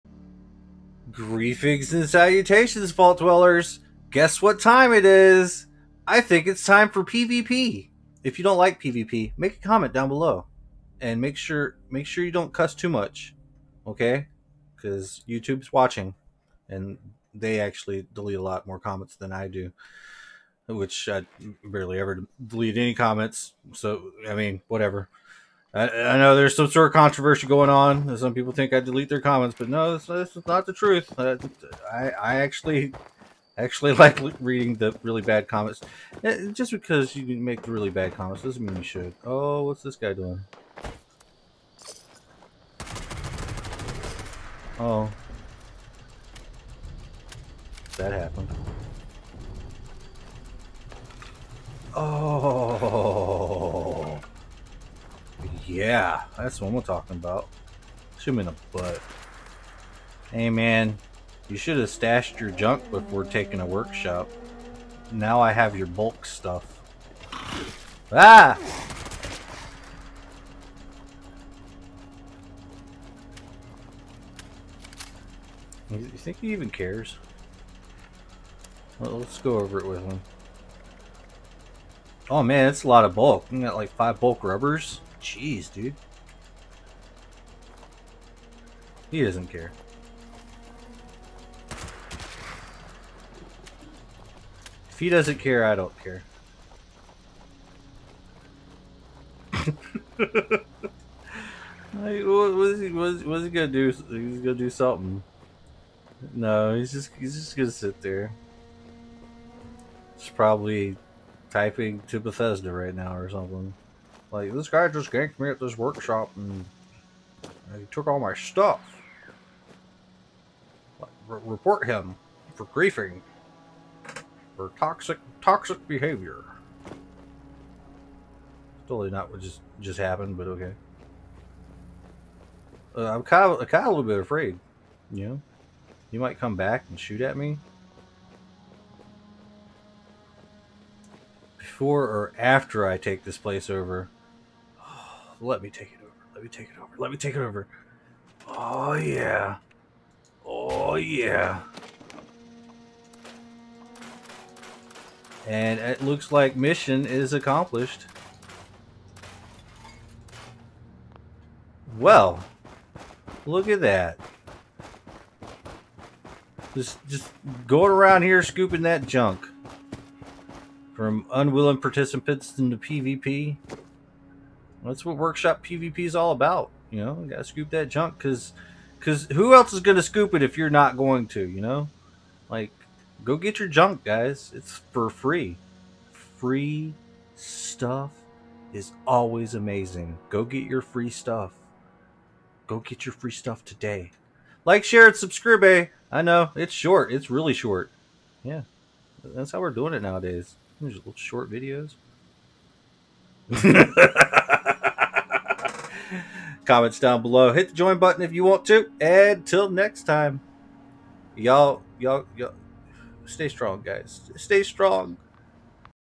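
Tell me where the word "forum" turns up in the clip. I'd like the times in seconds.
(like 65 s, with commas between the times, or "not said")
not said.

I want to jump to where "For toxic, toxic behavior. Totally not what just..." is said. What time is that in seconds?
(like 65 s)
124 s.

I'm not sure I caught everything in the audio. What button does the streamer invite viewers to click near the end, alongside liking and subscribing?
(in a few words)
Join button.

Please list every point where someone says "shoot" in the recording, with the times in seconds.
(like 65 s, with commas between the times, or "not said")
136 s.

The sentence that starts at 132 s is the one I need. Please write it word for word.
Uh, I'm kind of, kind of a little bit afraid, you know?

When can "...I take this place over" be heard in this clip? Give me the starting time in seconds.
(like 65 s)
142 s.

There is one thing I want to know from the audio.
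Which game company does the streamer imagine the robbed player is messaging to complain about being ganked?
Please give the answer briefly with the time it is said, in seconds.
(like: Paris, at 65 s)
Bethesda, at 112 s.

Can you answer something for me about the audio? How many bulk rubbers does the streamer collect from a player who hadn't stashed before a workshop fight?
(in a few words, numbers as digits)
5.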